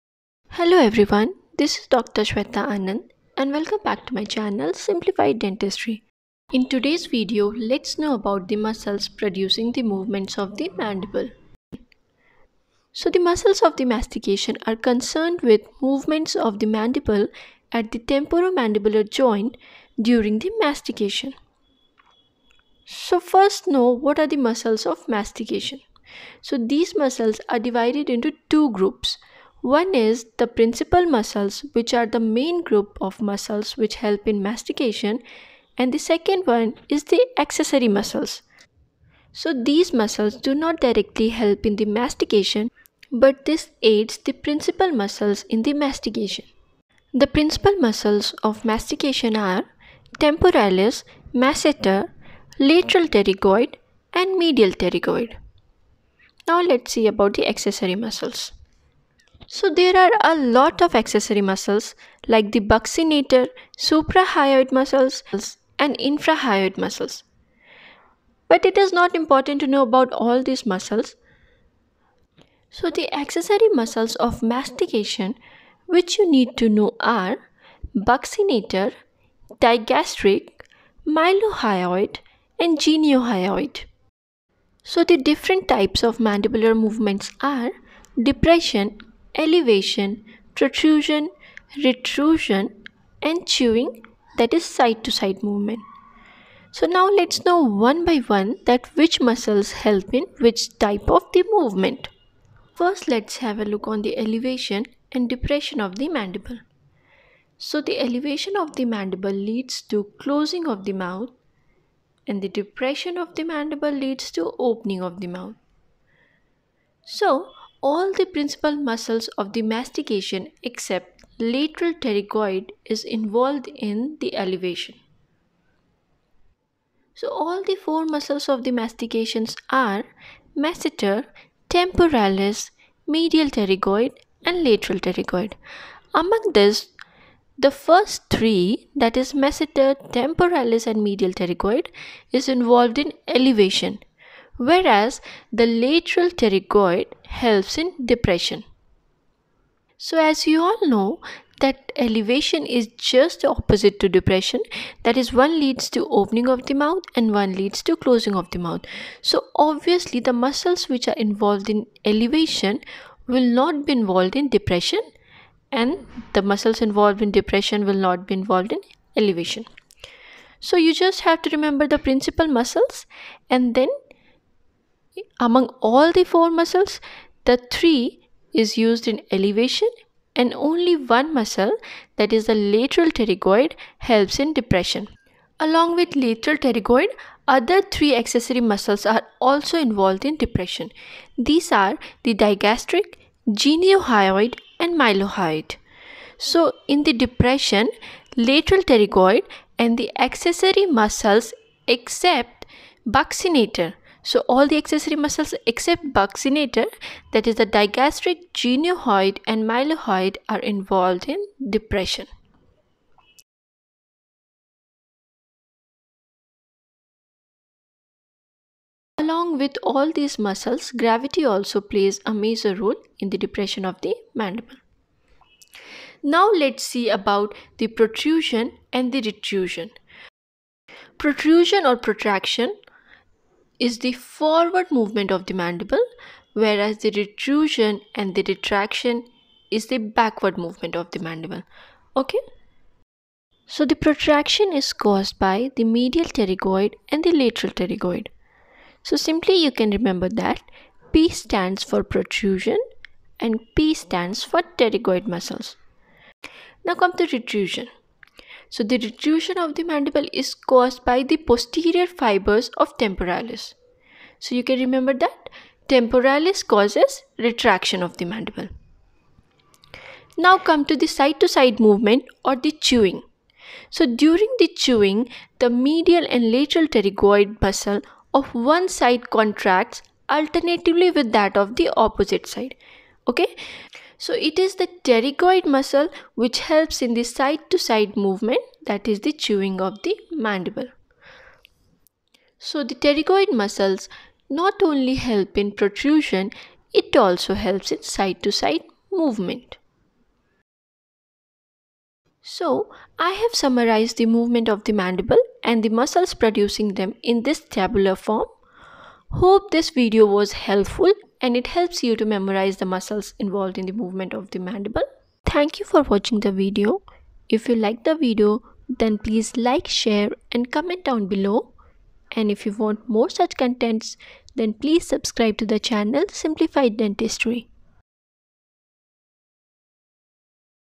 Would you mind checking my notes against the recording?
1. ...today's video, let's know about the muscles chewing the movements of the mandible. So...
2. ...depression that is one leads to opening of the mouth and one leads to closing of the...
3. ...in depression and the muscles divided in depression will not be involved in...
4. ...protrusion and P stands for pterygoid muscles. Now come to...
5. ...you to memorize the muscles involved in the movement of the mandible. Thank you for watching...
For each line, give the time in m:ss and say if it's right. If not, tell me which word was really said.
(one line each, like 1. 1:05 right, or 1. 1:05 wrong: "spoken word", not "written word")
1. 0:06 wrong: "producing", not "chewing"
2. 2:34 right
3. 2:44 wrong: "involved", not "divided"
4. 4:12 right
5. 5:12 right.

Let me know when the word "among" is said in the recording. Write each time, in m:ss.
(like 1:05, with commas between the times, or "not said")
2:16, 2:55.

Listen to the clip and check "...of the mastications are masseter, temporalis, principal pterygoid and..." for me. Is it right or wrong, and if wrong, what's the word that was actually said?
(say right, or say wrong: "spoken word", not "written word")
wrong: "medial", not "principal".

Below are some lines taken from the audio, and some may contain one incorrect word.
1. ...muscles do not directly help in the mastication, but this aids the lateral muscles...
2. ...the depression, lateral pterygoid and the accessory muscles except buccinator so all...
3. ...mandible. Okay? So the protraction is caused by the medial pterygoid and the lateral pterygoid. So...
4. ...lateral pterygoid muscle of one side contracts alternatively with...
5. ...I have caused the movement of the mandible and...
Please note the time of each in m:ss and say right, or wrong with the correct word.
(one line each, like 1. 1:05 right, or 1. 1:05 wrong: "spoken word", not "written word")
1. 0:39 wrong: "principal", not "lateral"
2. 3:17 right
3. 4:01 right
4. 4:36 right
5. 5:03 wrong: "summarized", not "caused".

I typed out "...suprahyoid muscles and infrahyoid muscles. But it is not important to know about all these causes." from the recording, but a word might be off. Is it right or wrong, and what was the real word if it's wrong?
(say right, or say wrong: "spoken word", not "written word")
wrong: "muscles", not "causes".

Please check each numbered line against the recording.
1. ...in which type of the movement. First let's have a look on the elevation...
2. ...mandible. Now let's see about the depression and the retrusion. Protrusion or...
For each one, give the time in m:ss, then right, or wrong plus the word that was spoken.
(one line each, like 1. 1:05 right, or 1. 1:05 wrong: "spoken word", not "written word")
1. 1:40 right
2. 3:44 wrong: "protrusion", not "depression".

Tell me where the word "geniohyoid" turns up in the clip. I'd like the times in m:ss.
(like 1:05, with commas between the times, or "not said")
1:22, 3:13, 3:28.